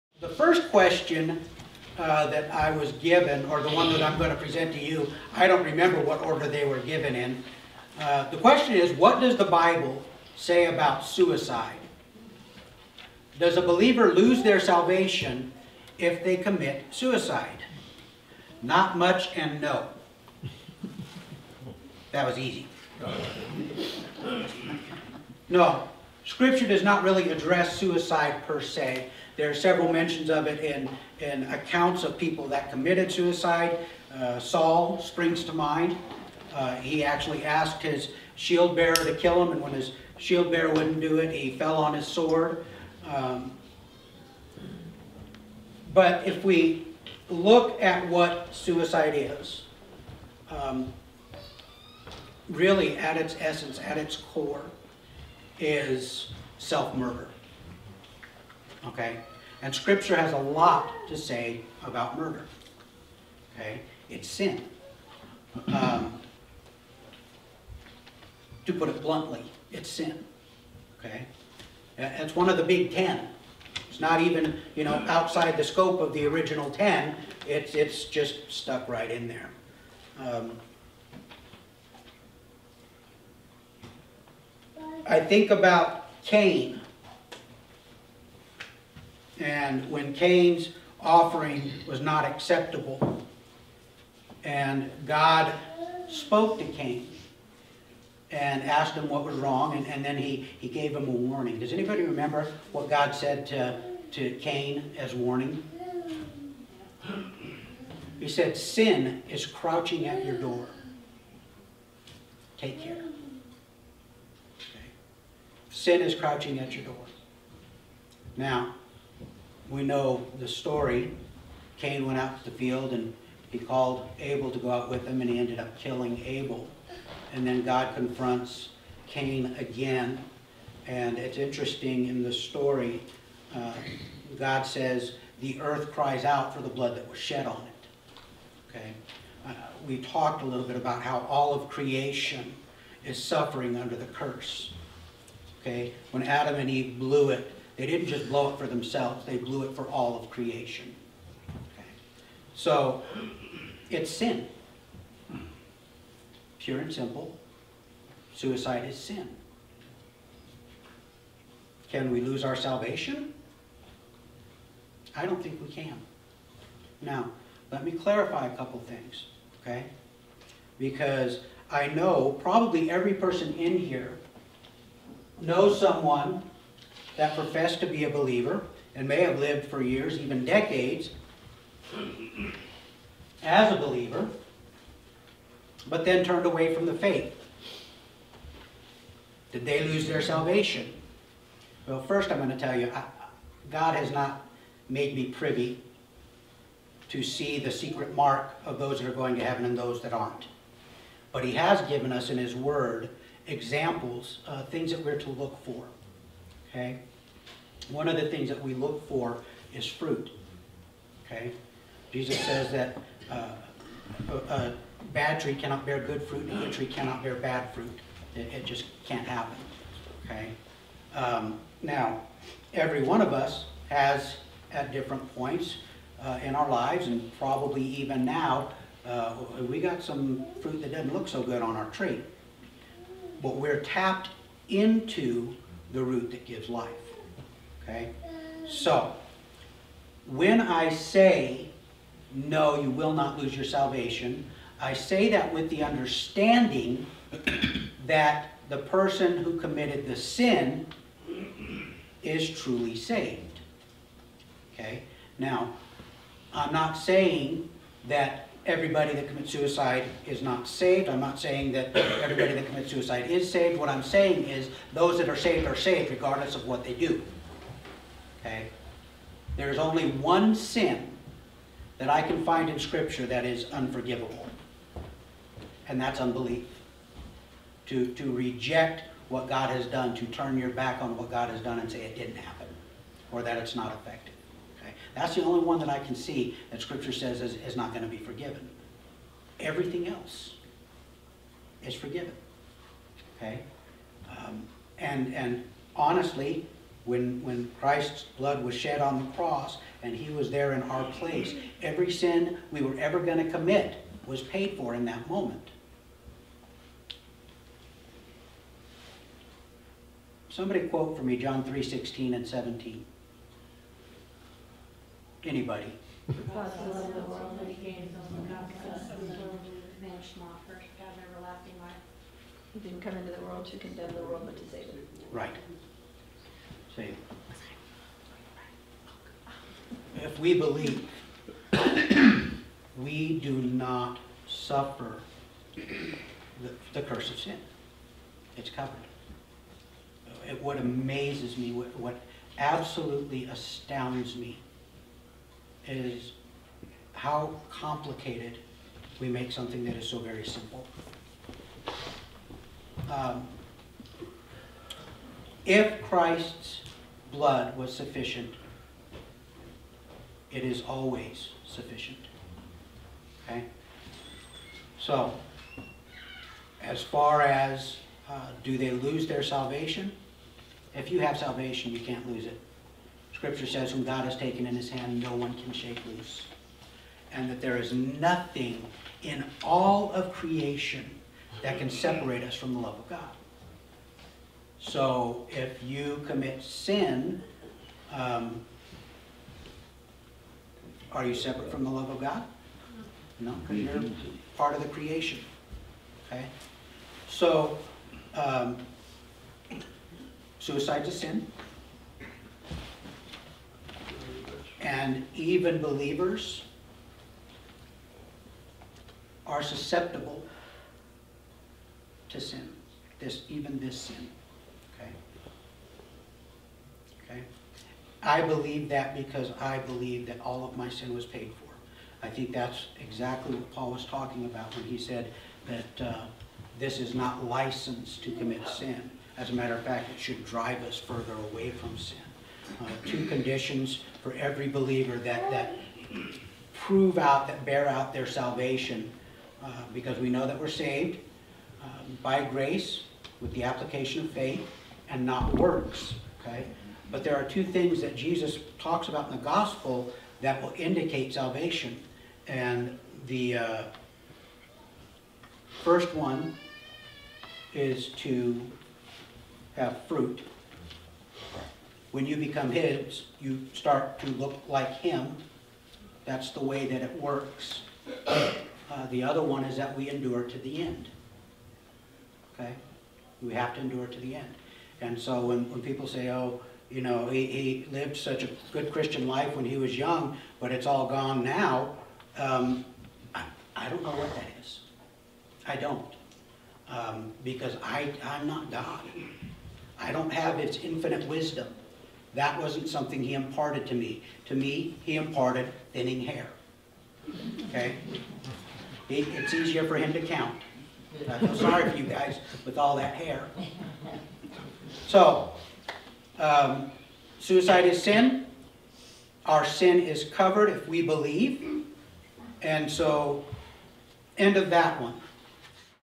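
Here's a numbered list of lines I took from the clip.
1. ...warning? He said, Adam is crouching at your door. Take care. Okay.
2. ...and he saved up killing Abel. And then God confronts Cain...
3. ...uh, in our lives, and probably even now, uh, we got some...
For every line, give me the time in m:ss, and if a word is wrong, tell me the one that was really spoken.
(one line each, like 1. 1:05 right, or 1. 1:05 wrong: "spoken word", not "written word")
1. 1:45 wrong: "Sin", not "Adam"
2. 2:05 wrong: "ended", not "saved"
3. 3:46 right.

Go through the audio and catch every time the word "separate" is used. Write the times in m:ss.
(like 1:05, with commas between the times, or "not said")
6:21, 6:31.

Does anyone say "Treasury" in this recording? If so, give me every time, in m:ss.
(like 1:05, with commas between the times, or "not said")
not said.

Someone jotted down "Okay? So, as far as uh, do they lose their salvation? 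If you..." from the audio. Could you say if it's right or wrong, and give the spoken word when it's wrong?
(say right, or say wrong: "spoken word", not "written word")
right.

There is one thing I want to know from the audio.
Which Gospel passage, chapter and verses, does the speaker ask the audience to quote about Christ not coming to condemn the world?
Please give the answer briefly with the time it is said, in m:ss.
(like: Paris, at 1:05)
John 3:16-17, at 5:11.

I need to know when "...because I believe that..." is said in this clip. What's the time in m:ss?
6:59.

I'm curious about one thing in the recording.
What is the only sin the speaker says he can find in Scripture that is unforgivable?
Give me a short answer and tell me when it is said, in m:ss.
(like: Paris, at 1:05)
Unbelief, at 4:36.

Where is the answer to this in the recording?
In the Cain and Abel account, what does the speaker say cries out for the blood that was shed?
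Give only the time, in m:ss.
2:15.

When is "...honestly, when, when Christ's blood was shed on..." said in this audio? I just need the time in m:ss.
4:55.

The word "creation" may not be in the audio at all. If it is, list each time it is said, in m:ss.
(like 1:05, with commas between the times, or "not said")
2:21, 2:30, 6:20, 6:34.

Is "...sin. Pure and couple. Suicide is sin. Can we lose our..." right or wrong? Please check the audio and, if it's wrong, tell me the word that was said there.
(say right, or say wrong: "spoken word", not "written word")
wrong: "simple", not "couple".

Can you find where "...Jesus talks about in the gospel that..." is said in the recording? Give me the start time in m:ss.
7:28.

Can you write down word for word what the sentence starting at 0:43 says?
Um, but if we look at what suicide is, um, really at its essence, at its core, is self-murder.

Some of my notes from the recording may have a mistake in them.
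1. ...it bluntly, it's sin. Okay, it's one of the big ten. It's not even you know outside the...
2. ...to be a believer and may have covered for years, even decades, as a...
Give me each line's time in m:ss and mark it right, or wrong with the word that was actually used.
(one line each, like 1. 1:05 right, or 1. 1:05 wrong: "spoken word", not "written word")
1. 1:08 right
2. 2:57 wrong: "lived", not "covered".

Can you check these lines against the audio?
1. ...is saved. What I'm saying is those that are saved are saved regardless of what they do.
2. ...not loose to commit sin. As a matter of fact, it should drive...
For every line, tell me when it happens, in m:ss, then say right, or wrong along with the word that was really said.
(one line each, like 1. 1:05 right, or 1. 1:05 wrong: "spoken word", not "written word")
1. 4:23 right
2. 7:07 wrong: "license", not "loose".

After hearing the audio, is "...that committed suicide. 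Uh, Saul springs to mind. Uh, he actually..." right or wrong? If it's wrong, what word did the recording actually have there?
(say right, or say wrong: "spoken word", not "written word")
right.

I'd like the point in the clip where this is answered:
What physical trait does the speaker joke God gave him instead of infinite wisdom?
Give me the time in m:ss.
8:15.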